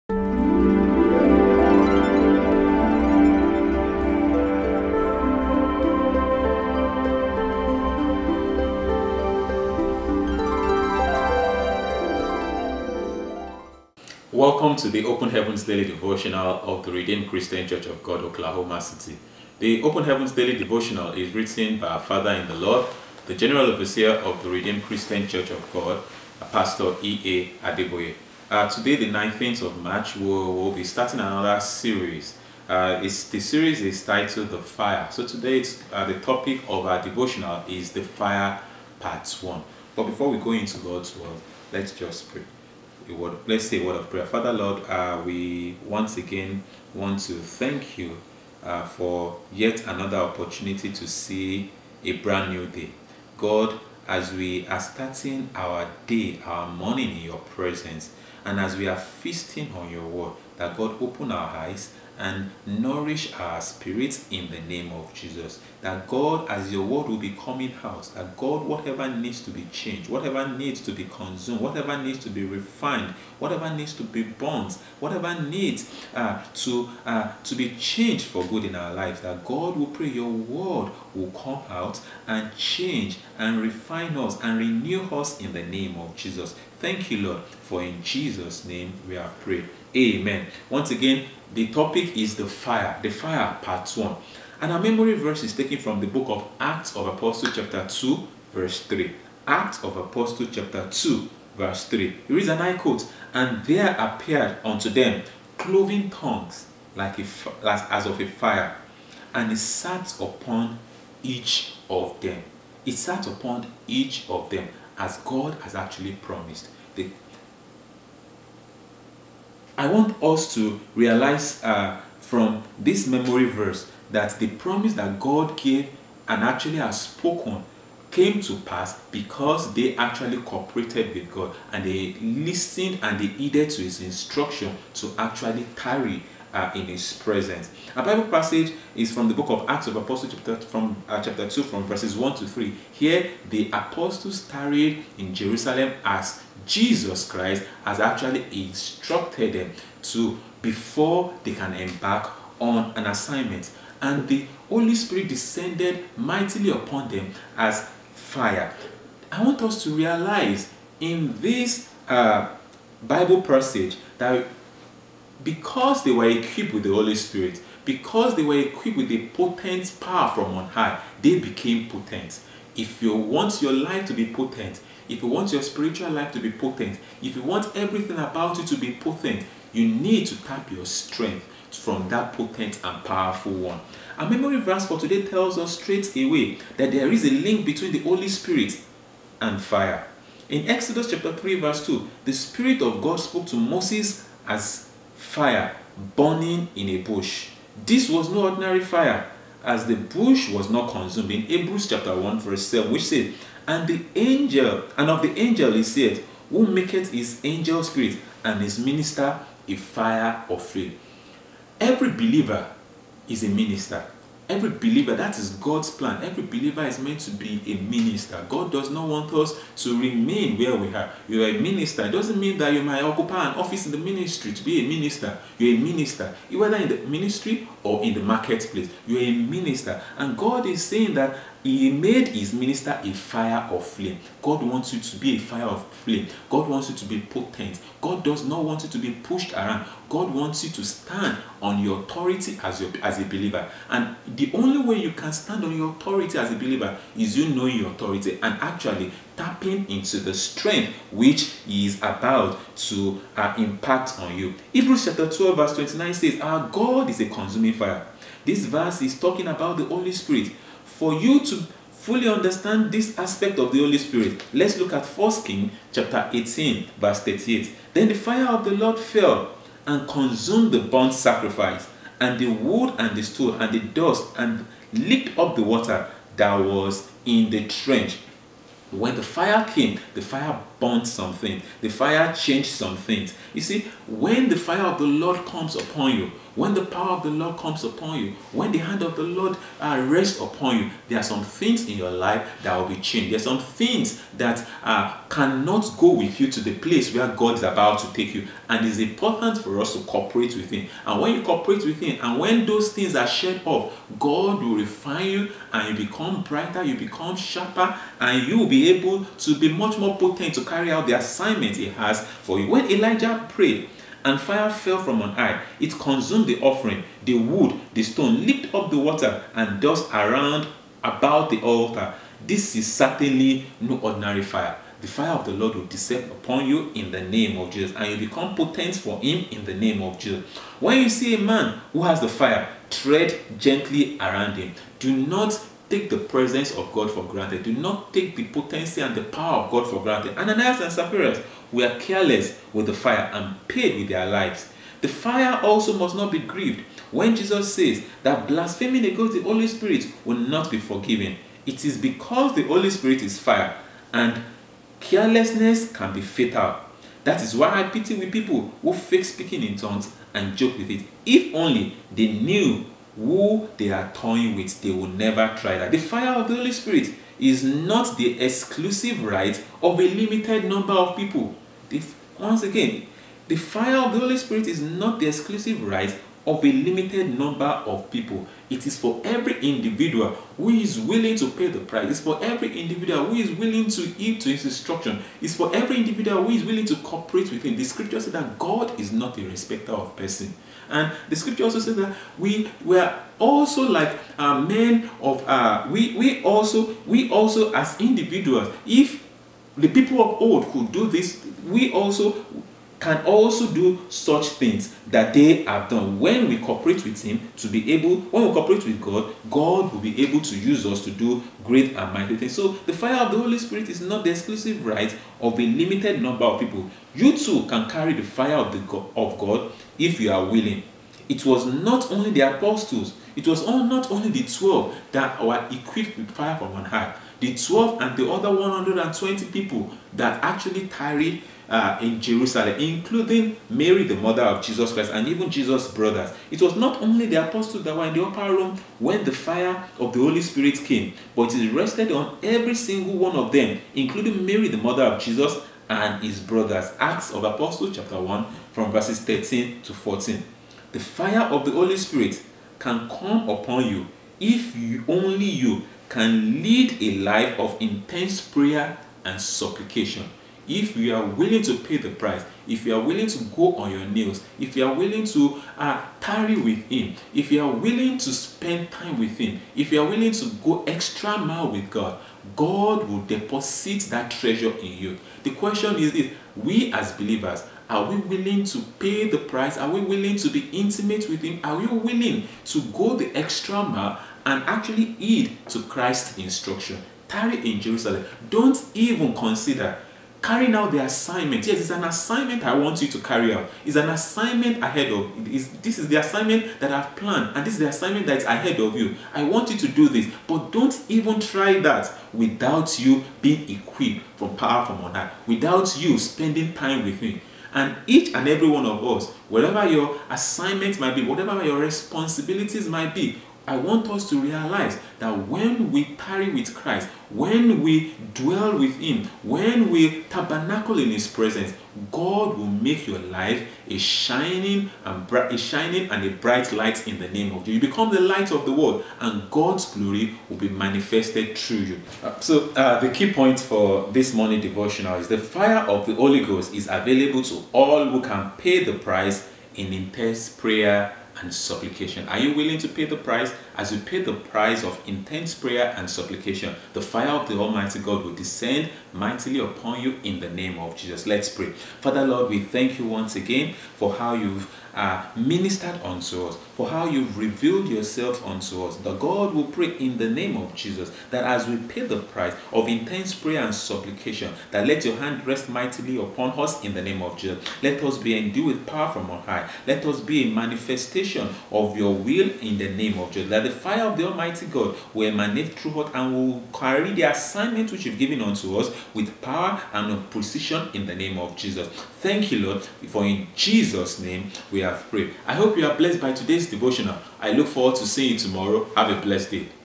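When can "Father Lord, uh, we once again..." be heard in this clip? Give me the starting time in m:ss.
0:44.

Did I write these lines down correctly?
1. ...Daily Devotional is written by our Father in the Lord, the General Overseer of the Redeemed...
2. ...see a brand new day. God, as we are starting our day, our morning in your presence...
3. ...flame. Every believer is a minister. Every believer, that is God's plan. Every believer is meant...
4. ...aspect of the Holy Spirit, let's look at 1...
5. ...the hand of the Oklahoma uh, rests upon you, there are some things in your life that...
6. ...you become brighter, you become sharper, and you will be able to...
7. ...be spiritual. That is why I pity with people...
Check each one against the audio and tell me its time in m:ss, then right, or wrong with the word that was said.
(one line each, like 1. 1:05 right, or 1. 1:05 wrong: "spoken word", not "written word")
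1. 0:20 right
2. 0:51 right
3. 3:30 right
4. 4:23 right
5. 4:48 wrong: "Lord", not "Oklahoma"
6. 5:05 right
7. 5:56 wrong: "fatal", not "spiritual".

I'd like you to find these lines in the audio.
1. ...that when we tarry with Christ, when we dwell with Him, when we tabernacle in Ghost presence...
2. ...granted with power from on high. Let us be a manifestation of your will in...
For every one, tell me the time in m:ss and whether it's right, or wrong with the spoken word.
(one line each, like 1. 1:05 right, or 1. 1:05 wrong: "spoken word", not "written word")
1. 8:35 wrong: "His", not "Ghost"
2. 9:28 wrong: "endued", not "granted".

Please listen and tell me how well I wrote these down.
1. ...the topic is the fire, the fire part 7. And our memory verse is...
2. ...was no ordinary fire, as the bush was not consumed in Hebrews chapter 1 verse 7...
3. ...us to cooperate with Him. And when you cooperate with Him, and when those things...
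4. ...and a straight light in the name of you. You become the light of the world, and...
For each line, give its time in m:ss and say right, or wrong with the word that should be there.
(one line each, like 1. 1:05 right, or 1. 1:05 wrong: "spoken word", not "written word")
1. 1:31 wrong: "1", not "7"
2. 3:18 right
3. 4:59 right
4. 8:46 wrong: "bright", not "straight".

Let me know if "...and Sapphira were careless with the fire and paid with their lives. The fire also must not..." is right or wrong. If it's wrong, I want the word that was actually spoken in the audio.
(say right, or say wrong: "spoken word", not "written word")
right.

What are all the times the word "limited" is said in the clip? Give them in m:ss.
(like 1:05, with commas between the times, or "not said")
6:10, 6:16, 6:55.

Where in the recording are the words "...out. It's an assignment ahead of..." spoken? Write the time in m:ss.
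8:13.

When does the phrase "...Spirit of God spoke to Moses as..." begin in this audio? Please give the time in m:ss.
3:12.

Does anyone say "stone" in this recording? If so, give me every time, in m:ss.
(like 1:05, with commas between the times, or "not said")
5:18.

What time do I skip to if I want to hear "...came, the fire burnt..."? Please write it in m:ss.
4:39.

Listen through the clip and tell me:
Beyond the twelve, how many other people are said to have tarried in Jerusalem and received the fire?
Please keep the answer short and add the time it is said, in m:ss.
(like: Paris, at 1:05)
120, at 7:08.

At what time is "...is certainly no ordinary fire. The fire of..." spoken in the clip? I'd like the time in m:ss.
5:22.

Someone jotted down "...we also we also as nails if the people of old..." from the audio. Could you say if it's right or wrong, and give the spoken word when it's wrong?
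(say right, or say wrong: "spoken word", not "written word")
wrong: "individuals", not "nails".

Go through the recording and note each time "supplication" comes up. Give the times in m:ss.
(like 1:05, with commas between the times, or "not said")
7:39, 9:01, 9:06, 9:23.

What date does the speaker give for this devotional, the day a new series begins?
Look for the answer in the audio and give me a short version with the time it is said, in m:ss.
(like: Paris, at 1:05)
19th of March, at 0:28.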